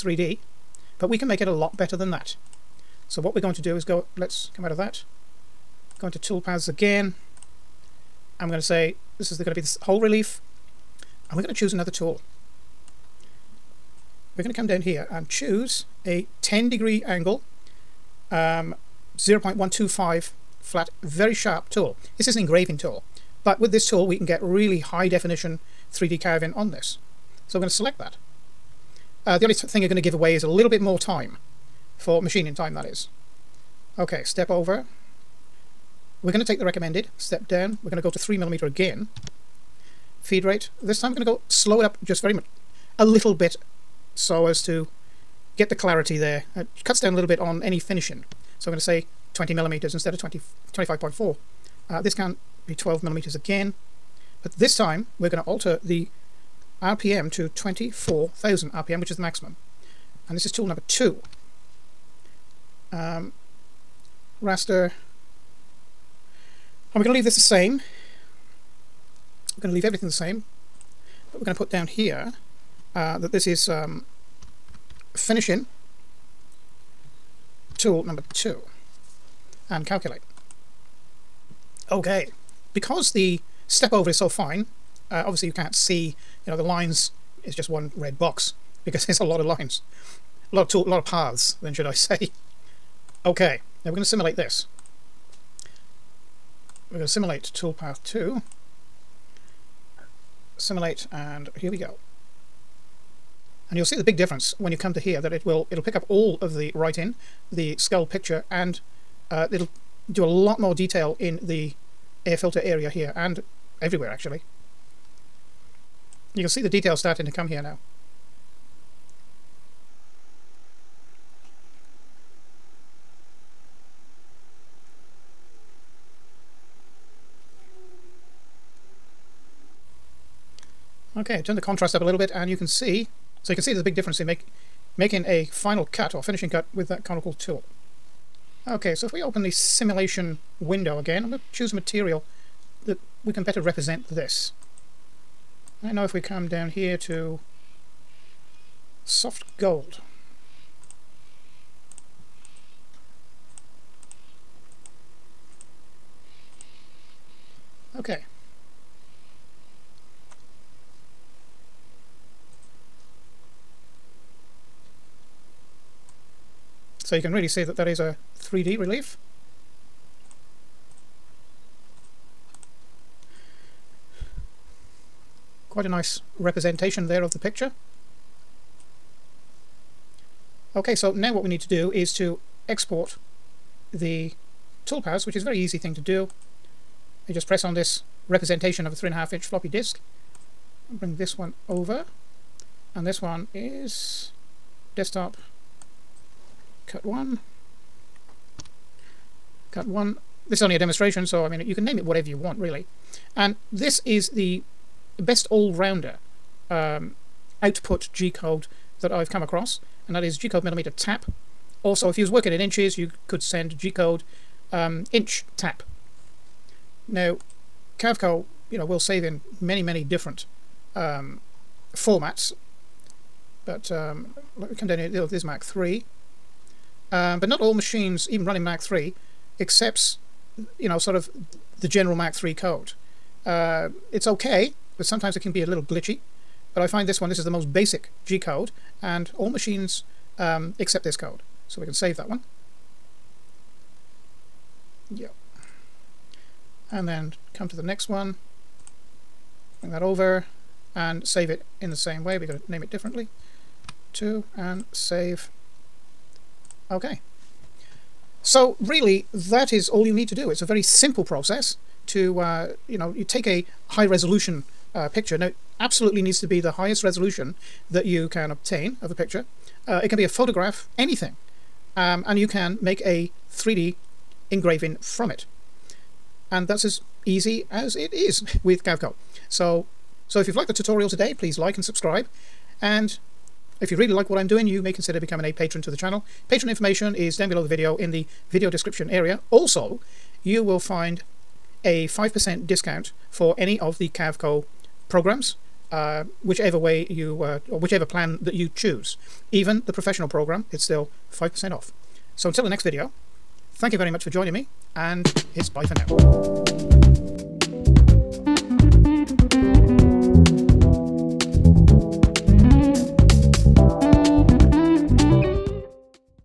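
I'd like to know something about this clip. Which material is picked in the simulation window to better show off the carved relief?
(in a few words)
soft gold.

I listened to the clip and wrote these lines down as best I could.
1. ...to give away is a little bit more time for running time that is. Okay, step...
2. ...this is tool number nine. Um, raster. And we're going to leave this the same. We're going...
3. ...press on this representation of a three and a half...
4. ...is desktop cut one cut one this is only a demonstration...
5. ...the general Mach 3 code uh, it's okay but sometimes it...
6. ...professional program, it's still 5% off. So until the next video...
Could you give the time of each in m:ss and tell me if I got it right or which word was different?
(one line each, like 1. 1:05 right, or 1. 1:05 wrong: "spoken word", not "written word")
1. 0:29 wrong: "machining", not "running"
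2. 1:00 wrong: "two", not "nine"
3. 3:07 right
4. 3:13 right
5. 3:51 right
6. 4:59 right.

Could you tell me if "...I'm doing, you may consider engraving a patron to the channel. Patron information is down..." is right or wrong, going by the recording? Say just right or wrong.
wrong.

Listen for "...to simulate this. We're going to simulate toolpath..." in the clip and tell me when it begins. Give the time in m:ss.
1:34.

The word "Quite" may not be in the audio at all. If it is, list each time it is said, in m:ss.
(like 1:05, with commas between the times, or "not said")
2:55.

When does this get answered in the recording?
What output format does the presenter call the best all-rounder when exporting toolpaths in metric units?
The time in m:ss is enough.
3:30.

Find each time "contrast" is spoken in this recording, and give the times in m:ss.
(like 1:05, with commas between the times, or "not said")
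2:11.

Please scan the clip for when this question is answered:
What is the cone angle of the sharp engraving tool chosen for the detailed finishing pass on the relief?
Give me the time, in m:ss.
0:16.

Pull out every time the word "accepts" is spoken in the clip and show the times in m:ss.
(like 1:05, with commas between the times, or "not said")
3:49, 4:00.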